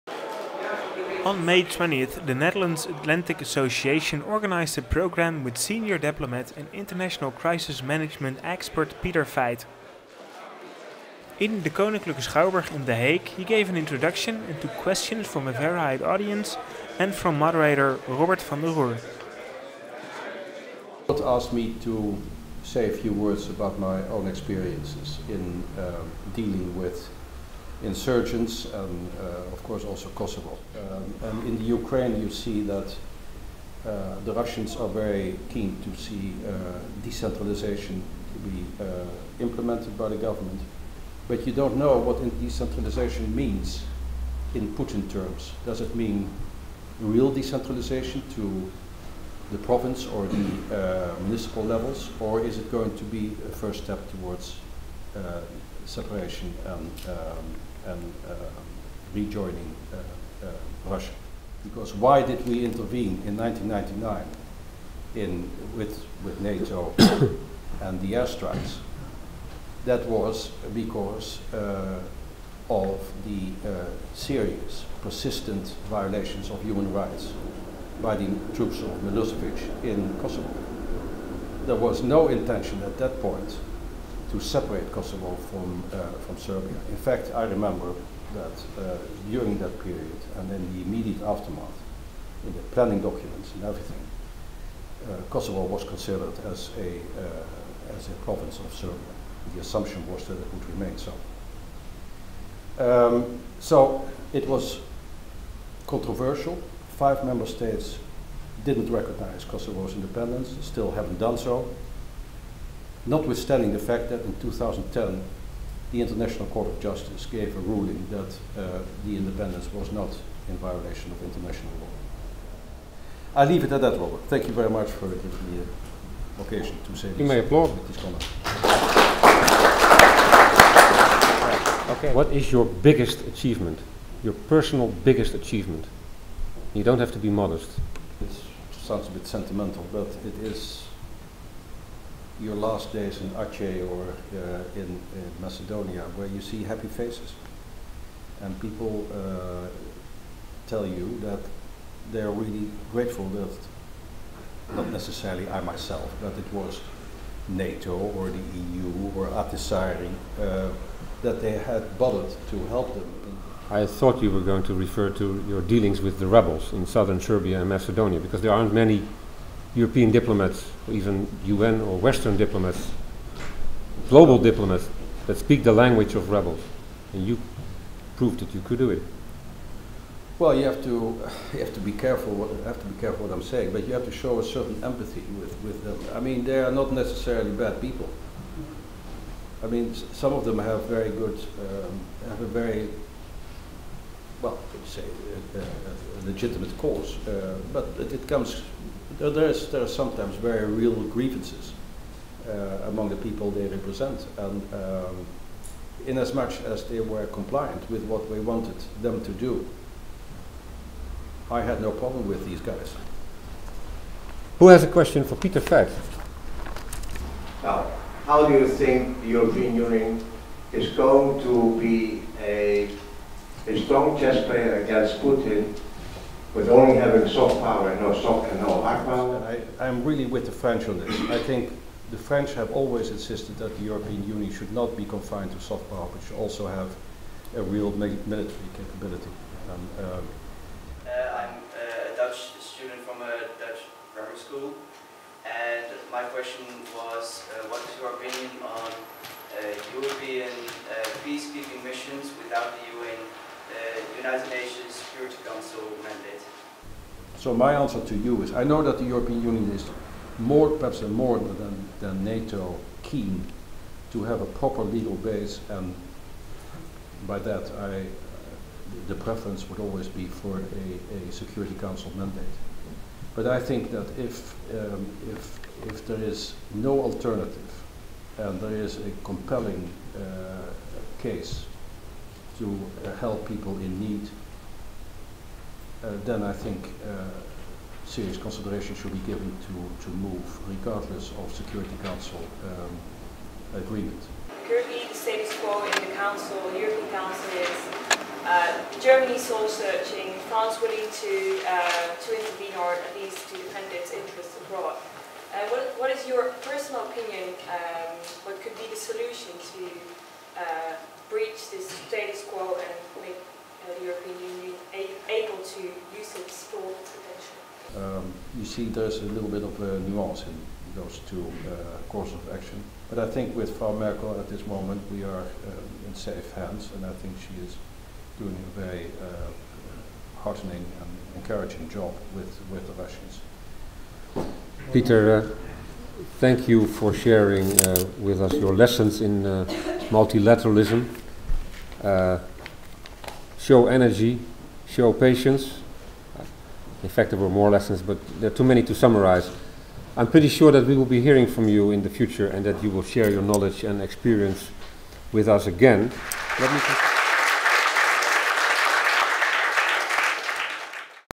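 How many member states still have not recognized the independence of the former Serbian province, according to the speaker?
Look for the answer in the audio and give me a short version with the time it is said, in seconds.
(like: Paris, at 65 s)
5, at 106 s.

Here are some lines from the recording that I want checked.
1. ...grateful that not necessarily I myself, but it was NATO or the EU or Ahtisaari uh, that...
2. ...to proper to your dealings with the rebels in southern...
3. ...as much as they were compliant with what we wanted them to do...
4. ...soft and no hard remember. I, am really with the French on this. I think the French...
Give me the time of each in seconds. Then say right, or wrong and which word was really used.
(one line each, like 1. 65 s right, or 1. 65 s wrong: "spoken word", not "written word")
1. 152 s right
2. 164 s wrong: "refer", not "proper"
3. 206 s right
4. 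228 s wrong: "power", not "remember".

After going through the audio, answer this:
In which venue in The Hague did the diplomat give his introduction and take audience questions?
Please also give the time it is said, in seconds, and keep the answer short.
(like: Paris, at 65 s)
Koninklijke Schouwburg, at 11 s.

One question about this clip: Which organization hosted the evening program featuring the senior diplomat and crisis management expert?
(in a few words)
Netherlands Atlantic Association.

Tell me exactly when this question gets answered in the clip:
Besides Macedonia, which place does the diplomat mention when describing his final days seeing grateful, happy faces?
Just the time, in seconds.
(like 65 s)
143 s.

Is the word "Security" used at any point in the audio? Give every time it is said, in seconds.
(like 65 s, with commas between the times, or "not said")
254 s, 271 s, 291 s.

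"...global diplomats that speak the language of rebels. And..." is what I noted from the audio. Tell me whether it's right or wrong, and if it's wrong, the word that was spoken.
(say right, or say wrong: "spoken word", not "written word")
right.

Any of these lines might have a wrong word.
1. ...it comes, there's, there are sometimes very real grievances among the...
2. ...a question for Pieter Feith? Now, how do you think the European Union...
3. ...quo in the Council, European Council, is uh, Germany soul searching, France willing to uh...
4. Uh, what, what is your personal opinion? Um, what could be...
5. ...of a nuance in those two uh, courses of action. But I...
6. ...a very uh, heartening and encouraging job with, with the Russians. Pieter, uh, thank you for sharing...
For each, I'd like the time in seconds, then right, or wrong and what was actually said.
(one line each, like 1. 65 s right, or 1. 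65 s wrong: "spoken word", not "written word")
1. 198 s right
2. 214 s right
3. 295 s right
4. 305 s right
5. 319 s right
6. 328 s right.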